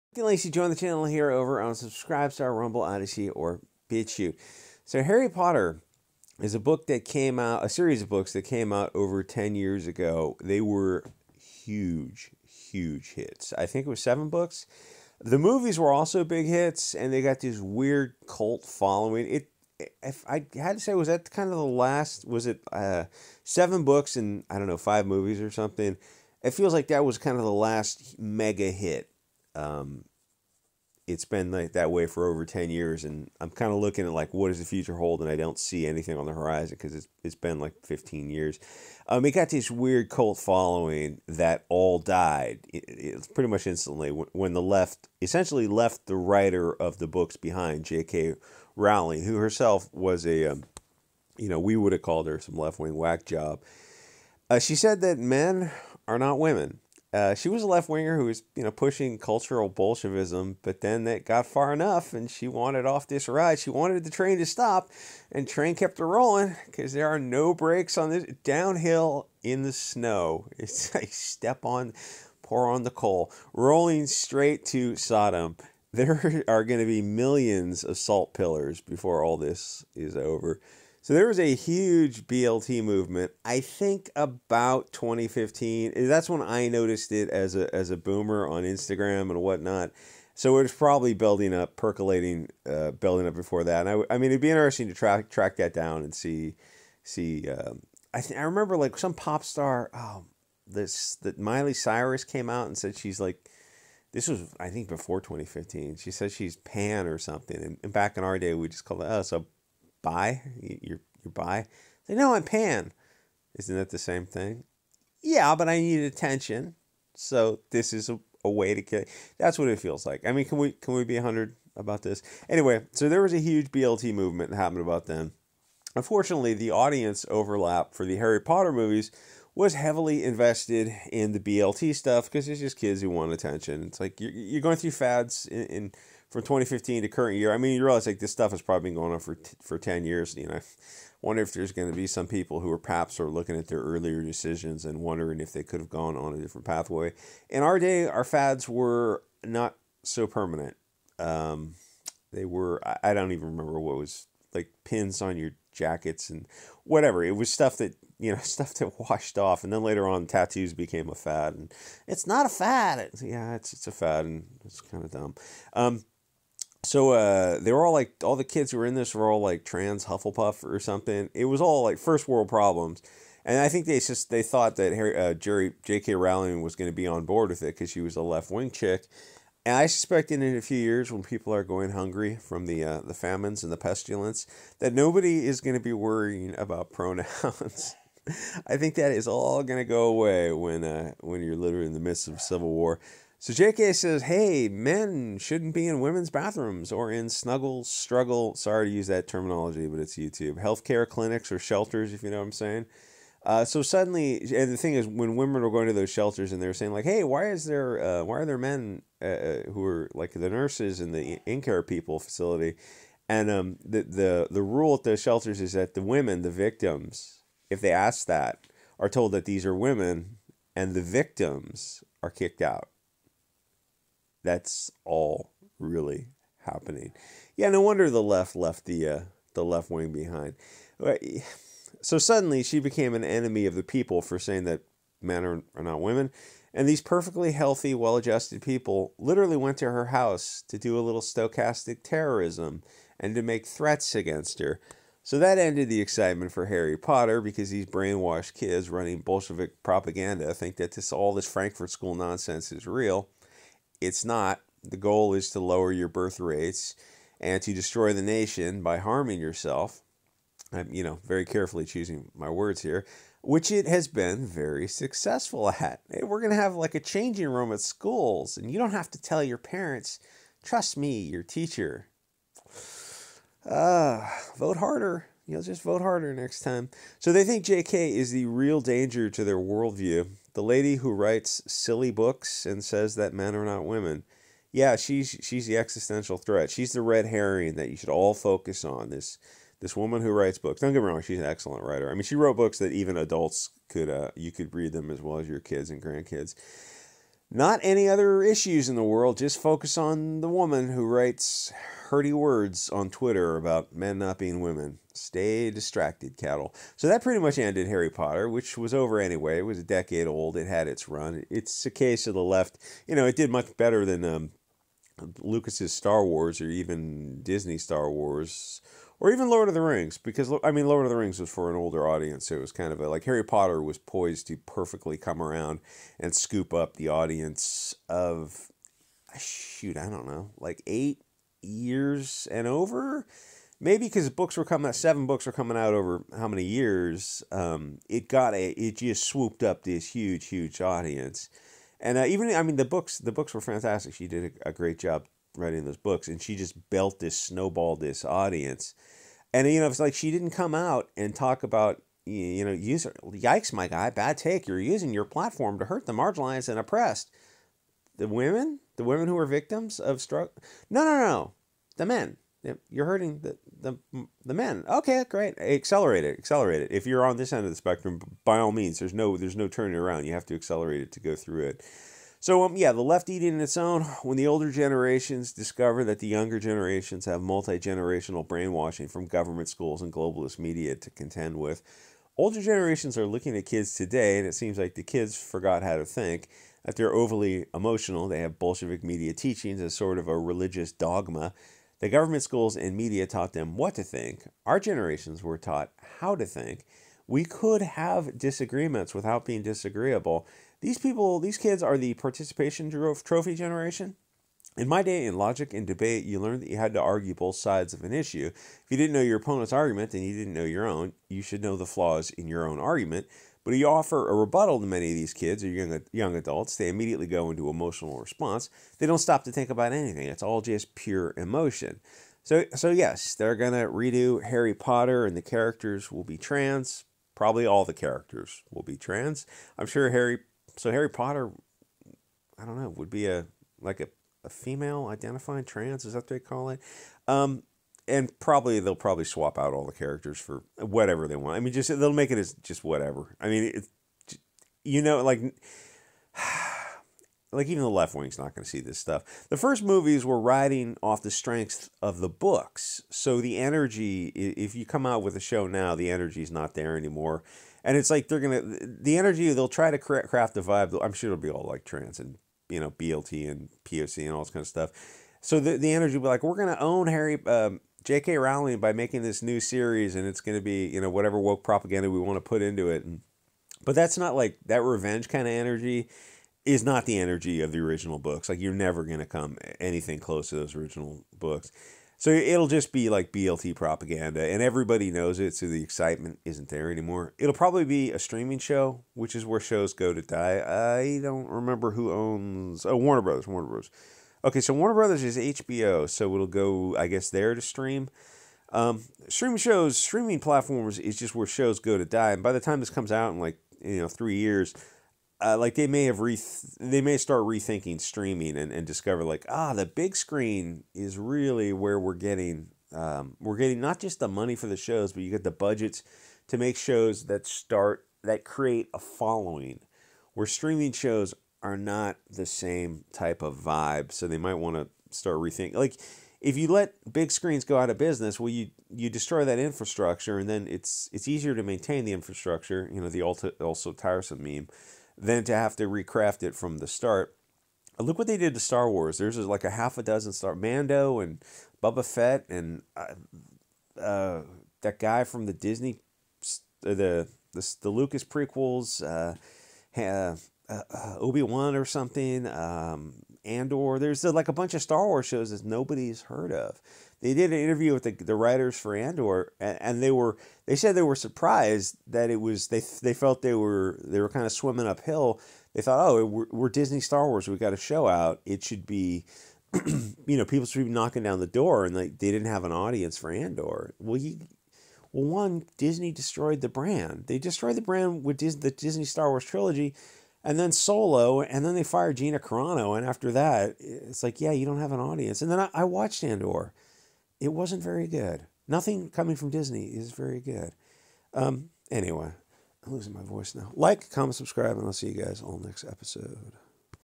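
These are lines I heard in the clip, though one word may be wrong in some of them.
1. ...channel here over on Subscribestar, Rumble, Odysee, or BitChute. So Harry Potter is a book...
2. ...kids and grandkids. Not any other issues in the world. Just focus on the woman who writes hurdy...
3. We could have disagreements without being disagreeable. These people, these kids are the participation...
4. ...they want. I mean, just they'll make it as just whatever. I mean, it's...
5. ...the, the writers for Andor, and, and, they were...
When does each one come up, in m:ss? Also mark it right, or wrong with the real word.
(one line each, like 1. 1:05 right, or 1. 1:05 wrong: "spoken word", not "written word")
1. 0:00 right
2. 4:55 right
3. 6:37 right
4. 7:21 right
5. 9:18 right.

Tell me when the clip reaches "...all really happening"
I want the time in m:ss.
3:45.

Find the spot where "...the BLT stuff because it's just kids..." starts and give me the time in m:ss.
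2:11.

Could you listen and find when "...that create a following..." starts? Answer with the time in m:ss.
8:38.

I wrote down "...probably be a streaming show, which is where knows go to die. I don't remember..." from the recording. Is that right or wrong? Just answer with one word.
wrong.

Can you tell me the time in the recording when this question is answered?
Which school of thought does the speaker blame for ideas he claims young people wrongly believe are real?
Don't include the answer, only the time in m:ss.
4:11.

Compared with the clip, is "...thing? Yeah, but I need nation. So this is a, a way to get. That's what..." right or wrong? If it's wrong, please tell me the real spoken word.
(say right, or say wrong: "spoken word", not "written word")
wrong: "attention", not "nation".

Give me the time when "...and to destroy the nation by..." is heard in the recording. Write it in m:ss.
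4:17.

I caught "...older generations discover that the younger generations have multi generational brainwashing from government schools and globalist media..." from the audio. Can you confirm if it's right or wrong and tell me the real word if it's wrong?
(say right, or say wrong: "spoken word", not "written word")
right.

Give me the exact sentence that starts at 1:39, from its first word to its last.
Oh, this that Miley Cyrus came out and said she's like.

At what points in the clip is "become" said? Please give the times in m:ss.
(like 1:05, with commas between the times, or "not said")
not said.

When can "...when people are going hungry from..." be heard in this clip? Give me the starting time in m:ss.
3:01.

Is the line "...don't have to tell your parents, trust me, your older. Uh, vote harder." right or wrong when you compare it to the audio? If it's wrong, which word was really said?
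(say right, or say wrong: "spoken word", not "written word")
wrong: "teacher", not "older".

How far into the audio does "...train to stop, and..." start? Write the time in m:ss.
1:04.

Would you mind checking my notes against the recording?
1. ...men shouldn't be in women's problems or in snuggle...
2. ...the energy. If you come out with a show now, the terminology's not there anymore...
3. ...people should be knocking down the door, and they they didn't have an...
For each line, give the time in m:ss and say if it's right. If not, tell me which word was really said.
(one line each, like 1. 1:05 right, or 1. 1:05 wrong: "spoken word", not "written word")
1. 3:14 wrong: "bathrooms", not "problems"
2. 7:33 wrong: "energy", not "terminology"
3. 9:30 right.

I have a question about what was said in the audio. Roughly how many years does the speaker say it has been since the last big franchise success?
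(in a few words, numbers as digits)
15 years.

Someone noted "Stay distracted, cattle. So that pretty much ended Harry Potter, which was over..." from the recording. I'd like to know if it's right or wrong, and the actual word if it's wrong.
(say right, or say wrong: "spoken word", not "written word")
right.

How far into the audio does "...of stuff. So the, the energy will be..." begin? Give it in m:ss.
7:44.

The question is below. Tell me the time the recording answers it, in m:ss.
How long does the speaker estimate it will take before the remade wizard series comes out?
8:24.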